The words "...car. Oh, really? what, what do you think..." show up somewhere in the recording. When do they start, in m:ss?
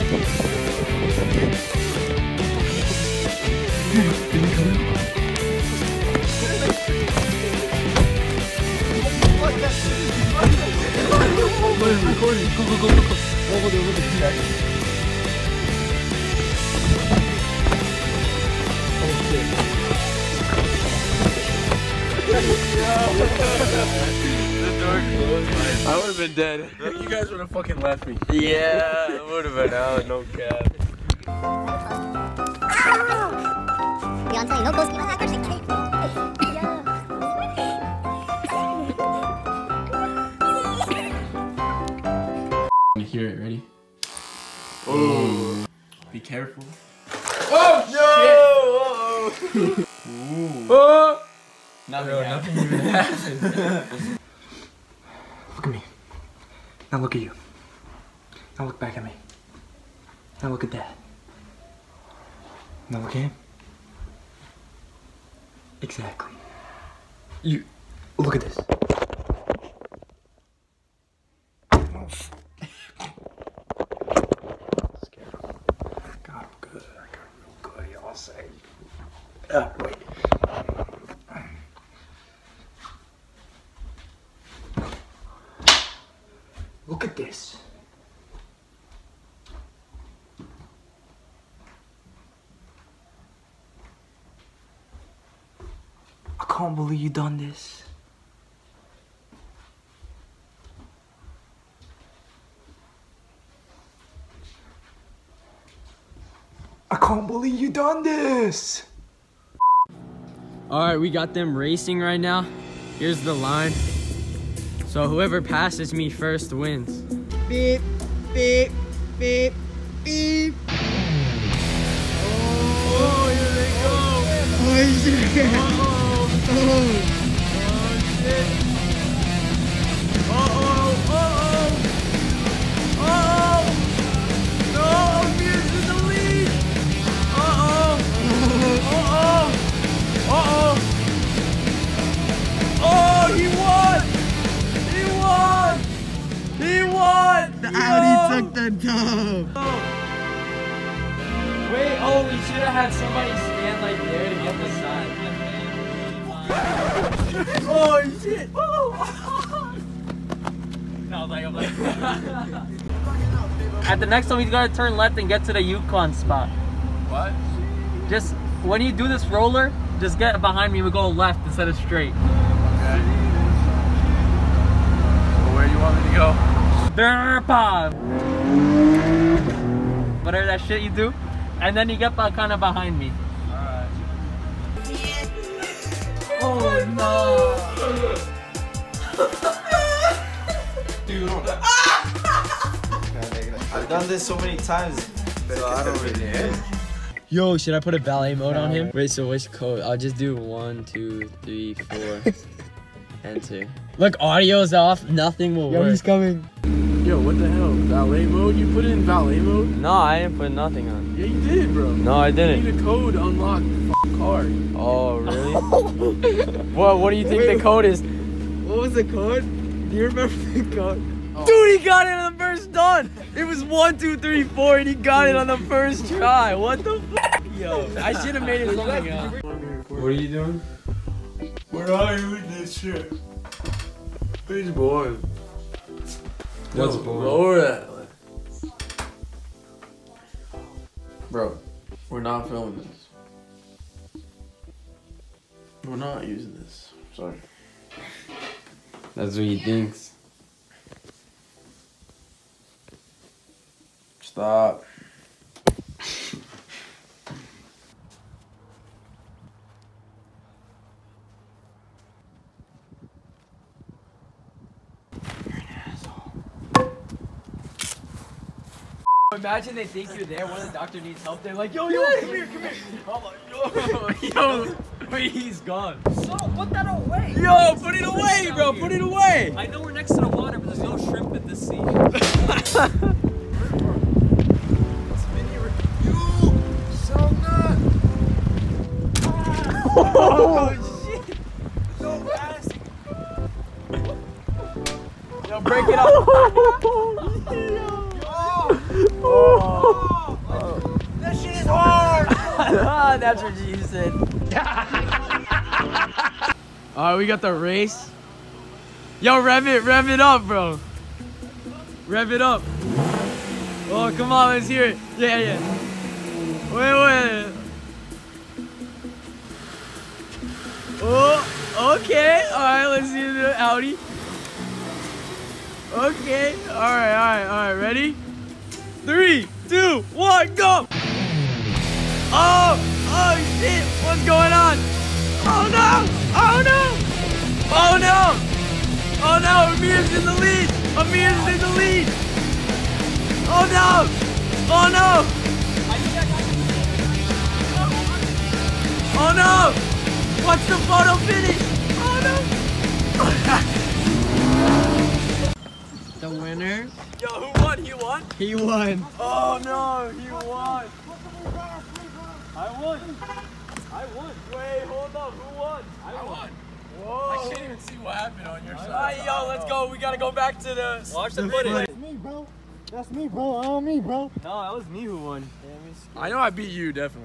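3:34.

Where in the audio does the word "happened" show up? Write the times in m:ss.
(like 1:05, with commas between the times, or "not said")
0:52, 6:08.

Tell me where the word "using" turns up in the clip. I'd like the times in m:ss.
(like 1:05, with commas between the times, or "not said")
4:06.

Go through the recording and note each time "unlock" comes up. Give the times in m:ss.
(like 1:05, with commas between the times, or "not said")
3:33.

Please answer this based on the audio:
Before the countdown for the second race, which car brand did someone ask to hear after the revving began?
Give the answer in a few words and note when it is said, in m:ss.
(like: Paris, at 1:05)
Audi, at 5:23.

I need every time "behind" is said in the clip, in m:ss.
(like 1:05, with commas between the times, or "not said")
2:50, 3:02.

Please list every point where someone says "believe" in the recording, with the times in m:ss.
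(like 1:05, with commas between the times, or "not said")
1:36, 1:47.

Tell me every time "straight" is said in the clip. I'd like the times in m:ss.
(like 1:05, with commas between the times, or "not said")
2:51.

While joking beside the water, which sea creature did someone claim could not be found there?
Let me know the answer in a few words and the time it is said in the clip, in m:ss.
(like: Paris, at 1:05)
shrimp, at 4:40.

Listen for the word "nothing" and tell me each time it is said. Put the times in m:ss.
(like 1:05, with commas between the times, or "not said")
0:51, 3:25, 3:30.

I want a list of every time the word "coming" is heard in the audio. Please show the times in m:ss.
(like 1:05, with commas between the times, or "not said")
3:26.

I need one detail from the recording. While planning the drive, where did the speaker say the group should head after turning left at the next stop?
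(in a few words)
Yukon spot.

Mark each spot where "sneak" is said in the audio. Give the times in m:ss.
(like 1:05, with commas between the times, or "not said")
not said.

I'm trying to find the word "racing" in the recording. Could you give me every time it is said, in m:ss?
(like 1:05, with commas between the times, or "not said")
1:51.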